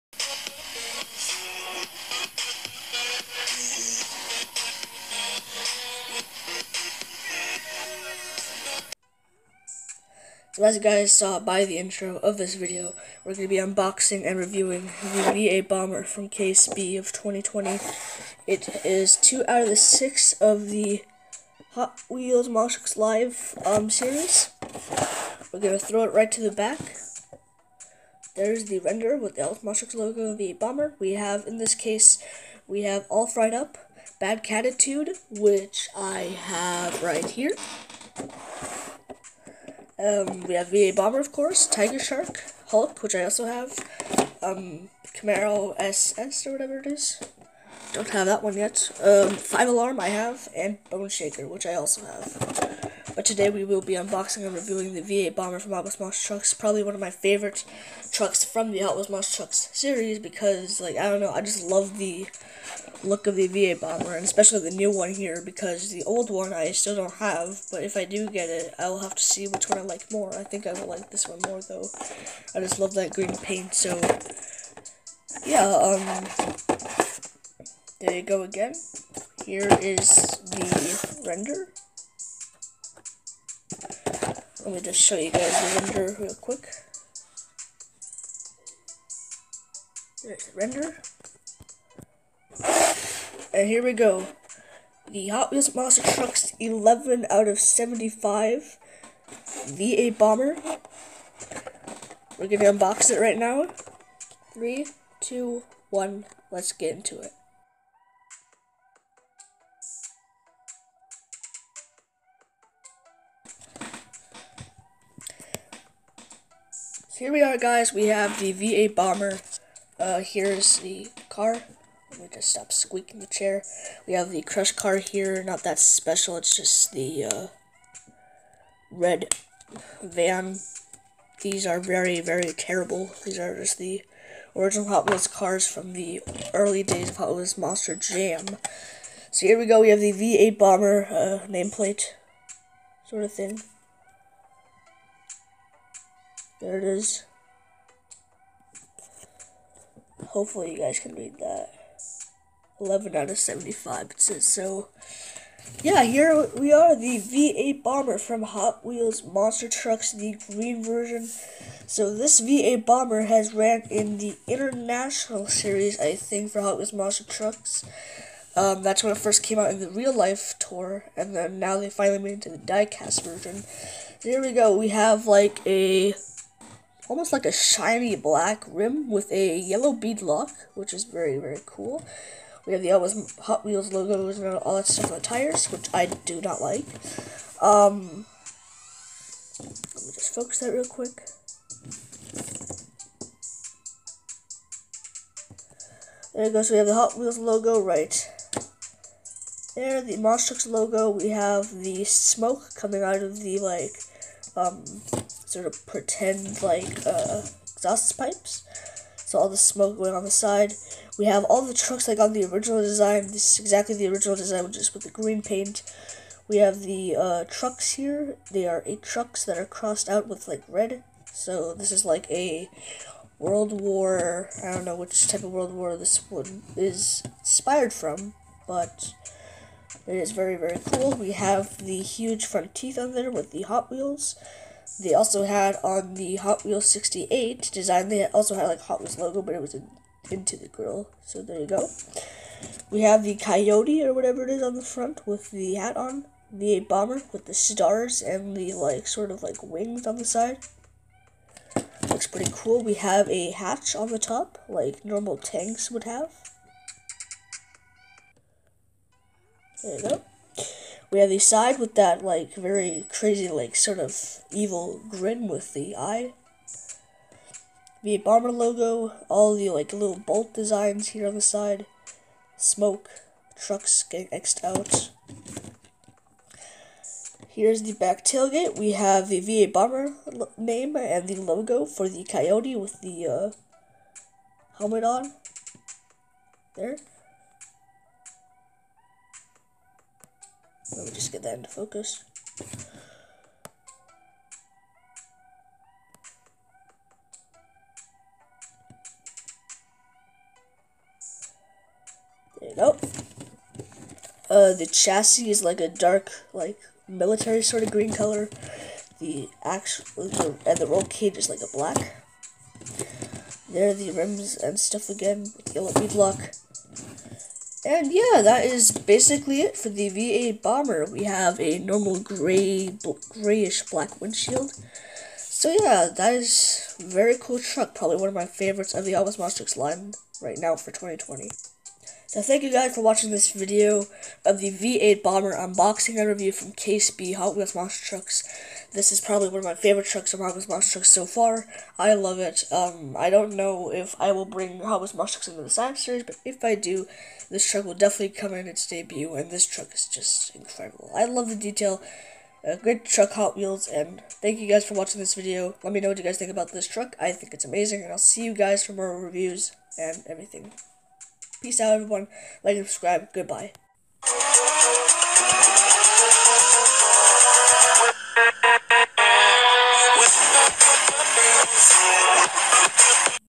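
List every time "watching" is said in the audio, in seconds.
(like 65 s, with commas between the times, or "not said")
333 s, 354 s.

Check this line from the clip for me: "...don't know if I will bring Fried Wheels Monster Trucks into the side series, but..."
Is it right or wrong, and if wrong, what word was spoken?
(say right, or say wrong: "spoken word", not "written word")
wrong: "Hot", not "Fried".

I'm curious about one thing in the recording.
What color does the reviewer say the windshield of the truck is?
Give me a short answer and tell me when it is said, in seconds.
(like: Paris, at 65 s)
grayish black, at 323 s.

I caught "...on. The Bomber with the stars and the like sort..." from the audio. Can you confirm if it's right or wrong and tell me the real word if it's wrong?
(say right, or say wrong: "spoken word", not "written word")
right.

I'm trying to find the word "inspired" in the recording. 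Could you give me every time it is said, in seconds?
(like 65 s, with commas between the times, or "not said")
227 s.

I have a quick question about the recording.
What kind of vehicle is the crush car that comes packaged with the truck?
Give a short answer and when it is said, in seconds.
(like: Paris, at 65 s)
red van, at 128 s.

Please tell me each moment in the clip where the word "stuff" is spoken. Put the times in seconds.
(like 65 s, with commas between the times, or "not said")
184 s, 314 s.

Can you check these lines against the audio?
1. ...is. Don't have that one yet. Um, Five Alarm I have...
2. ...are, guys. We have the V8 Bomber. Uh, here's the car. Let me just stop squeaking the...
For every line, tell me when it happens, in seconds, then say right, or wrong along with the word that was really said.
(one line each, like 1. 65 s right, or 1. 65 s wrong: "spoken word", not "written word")
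1. 46 s right
2. 117 s right.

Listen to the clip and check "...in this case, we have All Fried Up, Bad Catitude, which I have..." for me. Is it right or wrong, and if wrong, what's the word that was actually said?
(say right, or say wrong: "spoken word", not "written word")
right.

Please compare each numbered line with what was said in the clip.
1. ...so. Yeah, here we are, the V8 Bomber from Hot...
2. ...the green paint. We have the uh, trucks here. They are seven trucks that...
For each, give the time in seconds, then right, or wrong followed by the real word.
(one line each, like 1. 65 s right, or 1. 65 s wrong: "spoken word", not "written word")
1. 154 s right
2. 215 s wrong: "eight", not "seven".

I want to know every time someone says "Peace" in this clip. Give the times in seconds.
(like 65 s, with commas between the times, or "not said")
361 s.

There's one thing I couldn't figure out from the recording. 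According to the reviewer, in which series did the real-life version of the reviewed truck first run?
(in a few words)
International Series.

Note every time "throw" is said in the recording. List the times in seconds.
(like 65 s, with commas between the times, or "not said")
25 s.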